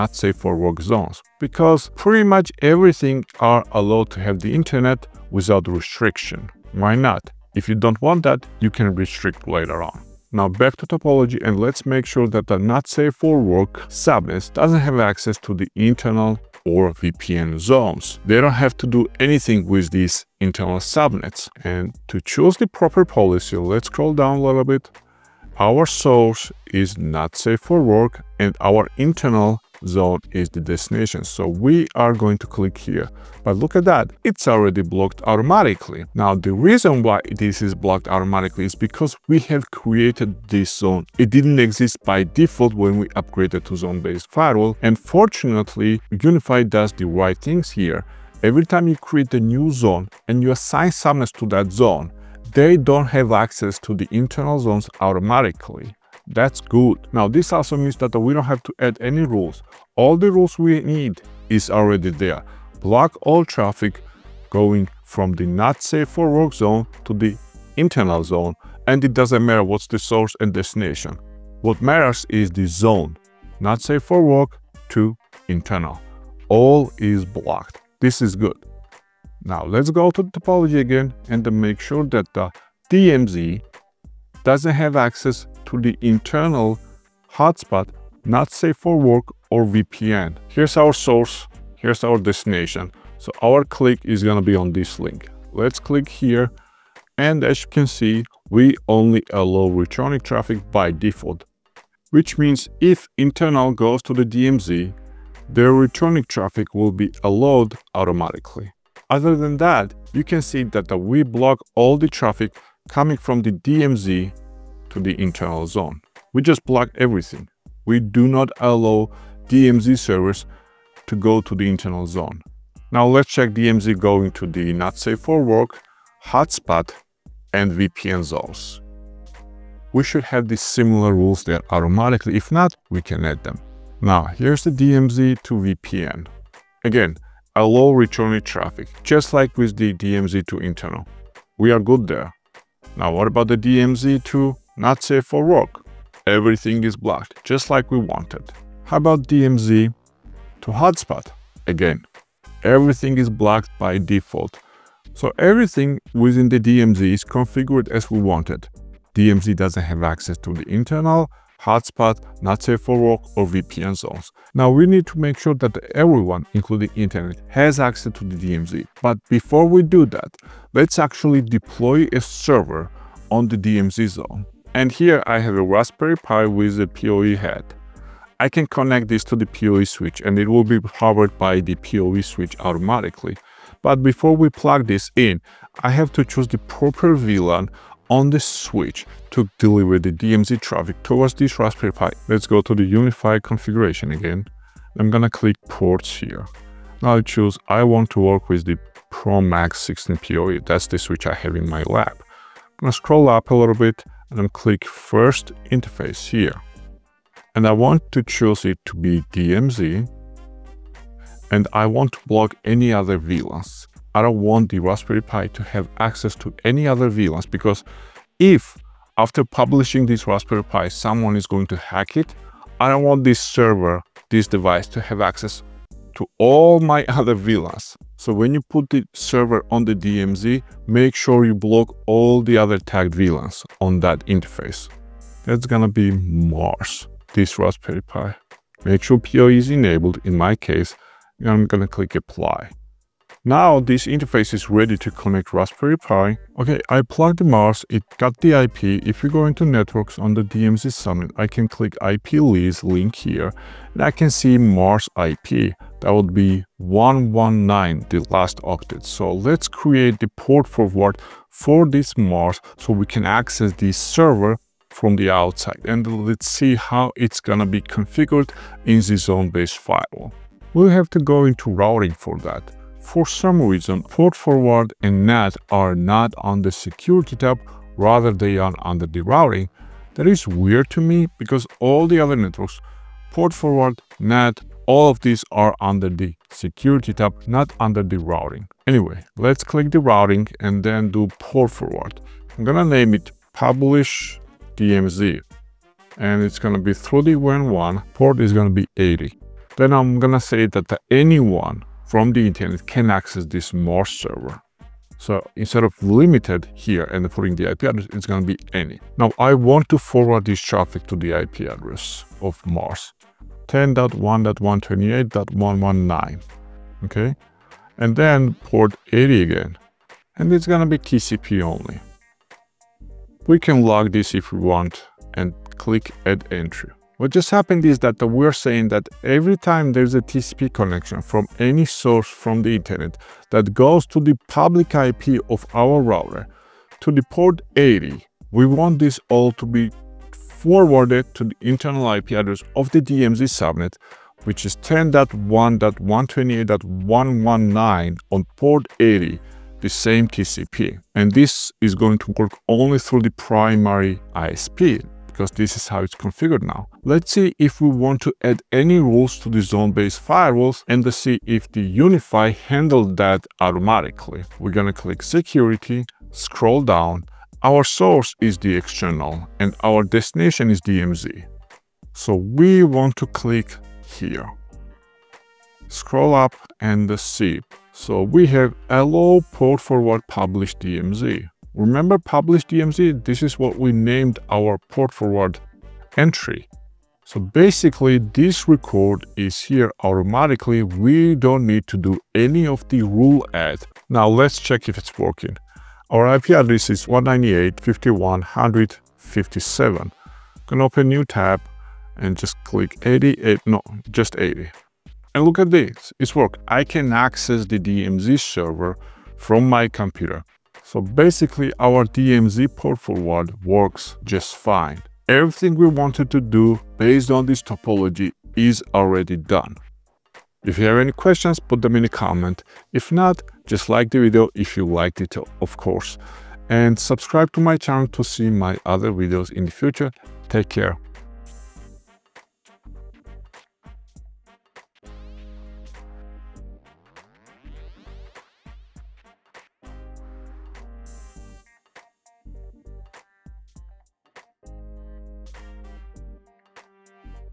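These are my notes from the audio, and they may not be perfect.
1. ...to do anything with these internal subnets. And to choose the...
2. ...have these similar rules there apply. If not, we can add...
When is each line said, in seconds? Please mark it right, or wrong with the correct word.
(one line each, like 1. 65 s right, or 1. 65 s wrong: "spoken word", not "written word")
1. 18 s right
2. 130 s wrong: "automatically", not "apply".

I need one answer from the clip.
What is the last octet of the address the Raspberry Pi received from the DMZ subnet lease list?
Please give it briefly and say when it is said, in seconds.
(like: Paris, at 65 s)
119, at 256 s.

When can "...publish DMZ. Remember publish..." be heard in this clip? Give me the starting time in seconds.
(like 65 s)
380 s.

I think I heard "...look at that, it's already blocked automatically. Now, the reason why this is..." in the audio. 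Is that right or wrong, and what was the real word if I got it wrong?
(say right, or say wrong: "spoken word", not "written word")
right.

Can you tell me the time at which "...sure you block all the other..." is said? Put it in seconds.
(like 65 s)
231 s.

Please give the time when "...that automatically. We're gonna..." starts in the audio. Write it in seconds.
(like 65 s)
363 s.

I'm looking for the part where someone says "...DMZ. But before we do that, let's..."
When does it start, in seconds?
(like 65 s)
168 s.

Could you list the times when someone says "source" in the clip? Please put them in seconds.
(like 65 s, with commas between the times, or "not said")
25 s, 69 s, 90 s, 331 s, 367 s.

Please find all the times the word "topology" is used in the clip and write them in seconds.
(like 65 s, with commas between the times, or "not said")
10 s, 80 s, 417 s.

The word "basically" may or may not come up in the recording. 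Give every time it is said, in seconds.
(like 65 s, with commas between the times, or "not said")
387 s, 410 s.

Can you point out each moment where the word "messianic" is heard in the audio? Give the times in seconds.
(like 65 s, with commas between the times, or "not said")
not said.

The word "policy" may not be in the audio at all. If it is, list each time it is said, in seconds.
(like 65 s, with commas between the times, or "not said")
23 s.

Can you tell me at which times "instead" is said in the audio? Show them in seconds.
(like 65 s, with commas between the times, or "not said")
305 s.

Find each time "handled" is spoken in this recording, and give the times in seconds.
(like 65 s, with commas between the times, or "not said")
362 s.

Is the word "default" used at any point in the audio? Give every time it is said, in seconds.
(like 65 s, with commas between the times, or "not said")
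42 s, 100 s, 153 s.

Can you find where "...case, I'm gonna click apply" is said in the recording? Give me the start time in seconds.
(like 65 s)
240 s.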